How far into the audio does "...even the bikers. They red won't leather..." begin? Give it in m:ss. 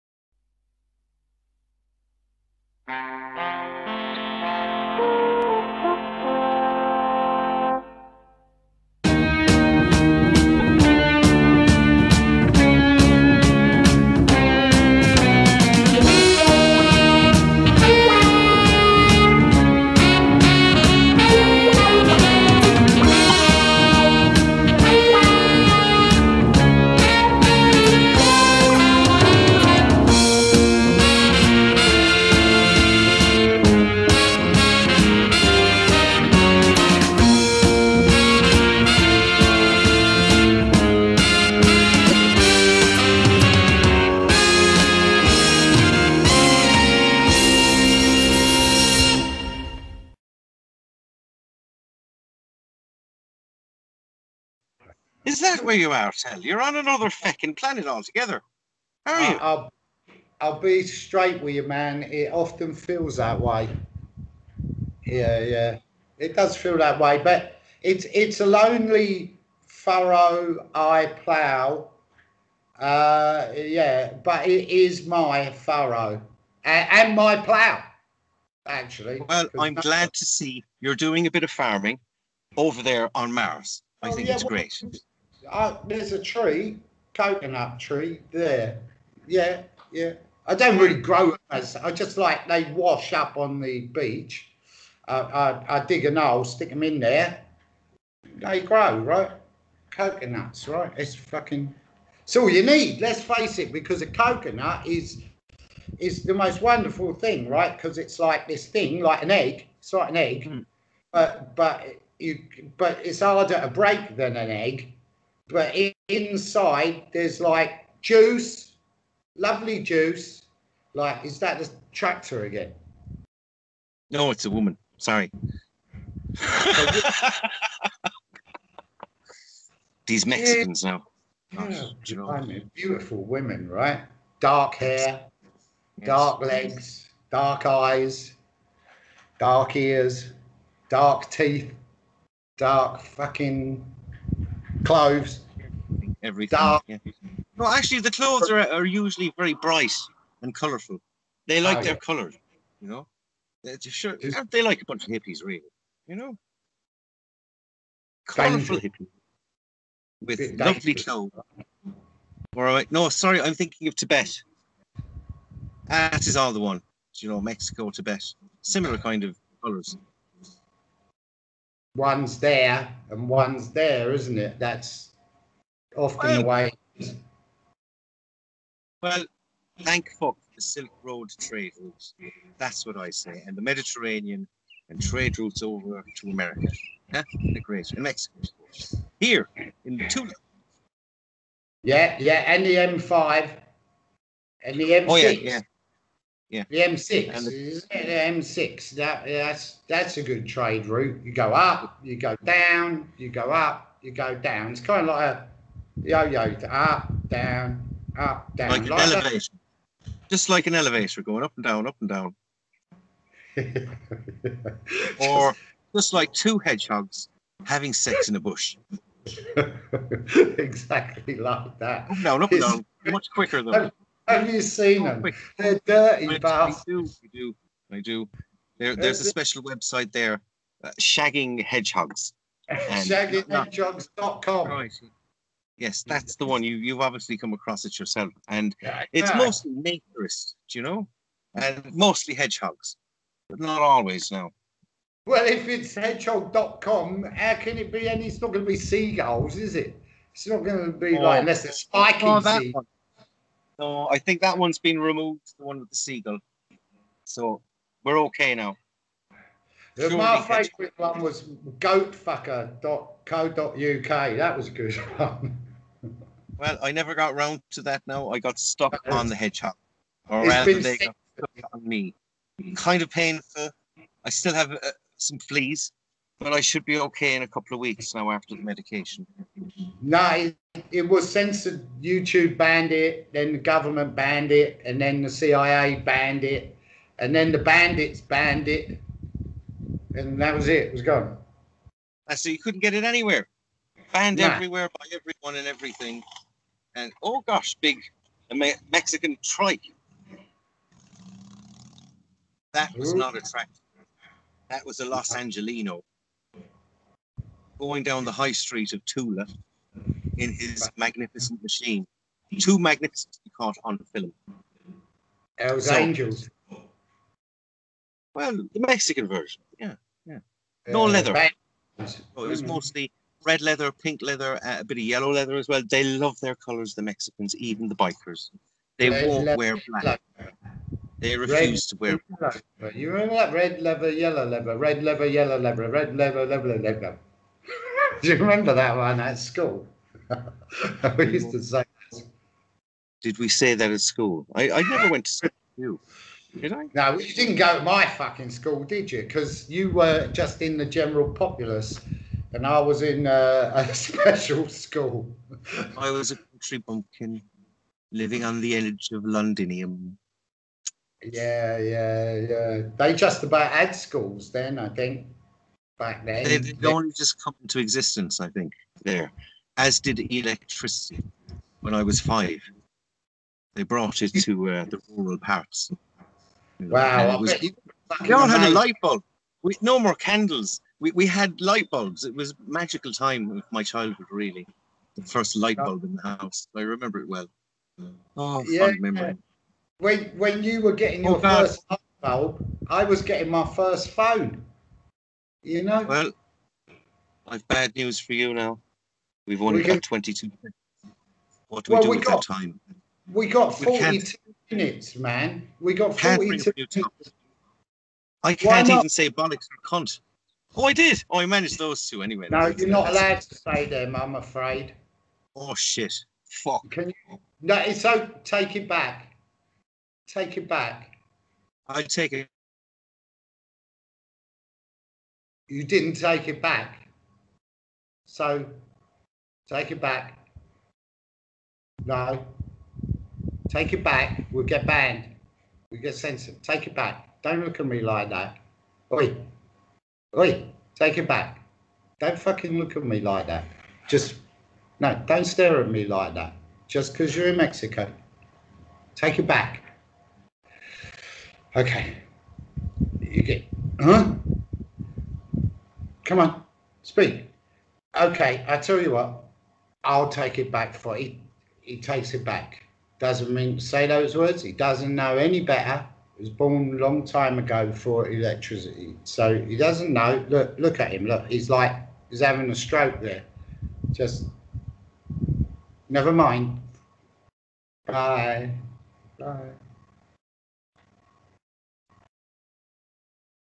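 5:27.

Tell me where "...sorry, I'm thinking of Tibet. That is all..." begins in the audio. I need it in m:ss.
2:43.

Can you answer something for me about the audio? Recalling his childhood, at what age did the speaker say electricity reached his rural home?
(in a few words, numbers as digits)
5.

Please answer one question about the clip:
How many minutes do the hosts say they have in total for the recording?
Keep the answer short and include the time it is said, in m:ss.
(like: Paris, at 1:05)
42, at 6:46.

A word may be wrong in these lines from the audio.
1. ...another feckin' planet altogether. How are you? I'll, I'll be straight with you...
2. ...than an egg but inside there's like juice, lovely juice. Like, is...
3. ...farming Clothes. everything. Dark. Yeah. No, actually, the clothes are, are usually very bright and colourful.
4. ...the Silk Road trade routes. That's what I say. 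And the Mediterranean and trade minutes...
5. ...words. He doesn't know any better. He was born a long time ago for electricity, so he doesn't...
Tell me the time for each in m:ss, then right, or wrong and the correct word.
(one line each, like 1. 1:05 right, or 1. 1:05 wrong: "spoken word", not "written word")
1. 0:56 right
2. 1:54 right
3. 2:23 wrong: "fucking", not "farming"
4. 3:00 wrong: "routes", not "minutes"
5. 7:44 right.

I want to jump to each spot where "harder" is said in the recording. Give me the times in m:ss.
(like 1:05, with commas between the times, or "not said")
1:53.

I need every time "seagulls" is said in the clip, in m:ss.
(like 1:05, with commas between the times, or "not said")
4:08, 4:15.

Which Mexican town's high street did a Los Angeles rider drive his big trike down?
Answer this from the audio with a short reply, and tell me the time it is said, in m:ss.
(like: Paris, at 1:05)
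Tula, at 5:09.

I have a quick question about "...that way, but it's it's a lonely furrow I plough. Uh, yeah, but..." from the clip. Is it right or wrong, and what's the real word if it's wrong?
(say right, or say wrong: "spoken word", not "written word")
right.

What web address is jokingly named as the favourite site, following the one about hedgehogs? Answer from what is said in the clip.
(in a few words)
goatfucker.co.uk.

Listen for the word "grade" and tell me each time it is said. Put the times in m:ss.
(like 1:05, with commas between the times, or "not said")
not said.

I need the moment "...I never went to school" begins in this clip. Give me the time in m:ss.
5:44.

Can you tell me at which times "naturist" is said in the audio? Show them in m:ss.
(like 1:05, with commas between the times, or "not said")
3:59.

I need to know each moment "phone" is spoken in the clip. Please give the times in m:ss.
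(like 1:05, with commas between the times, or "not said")
6:34.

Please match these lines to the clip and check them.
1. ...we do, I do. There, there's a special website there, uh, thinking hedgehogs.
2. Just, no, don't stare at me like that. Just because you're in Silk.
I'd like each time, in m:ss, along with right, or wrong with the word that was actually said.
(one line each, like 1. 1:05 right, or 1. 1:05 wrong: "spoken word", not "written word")
1. 3:47 wrong: "shagging", not "thinking"
2. 7:24 wrong: "Mexico", not "Silk".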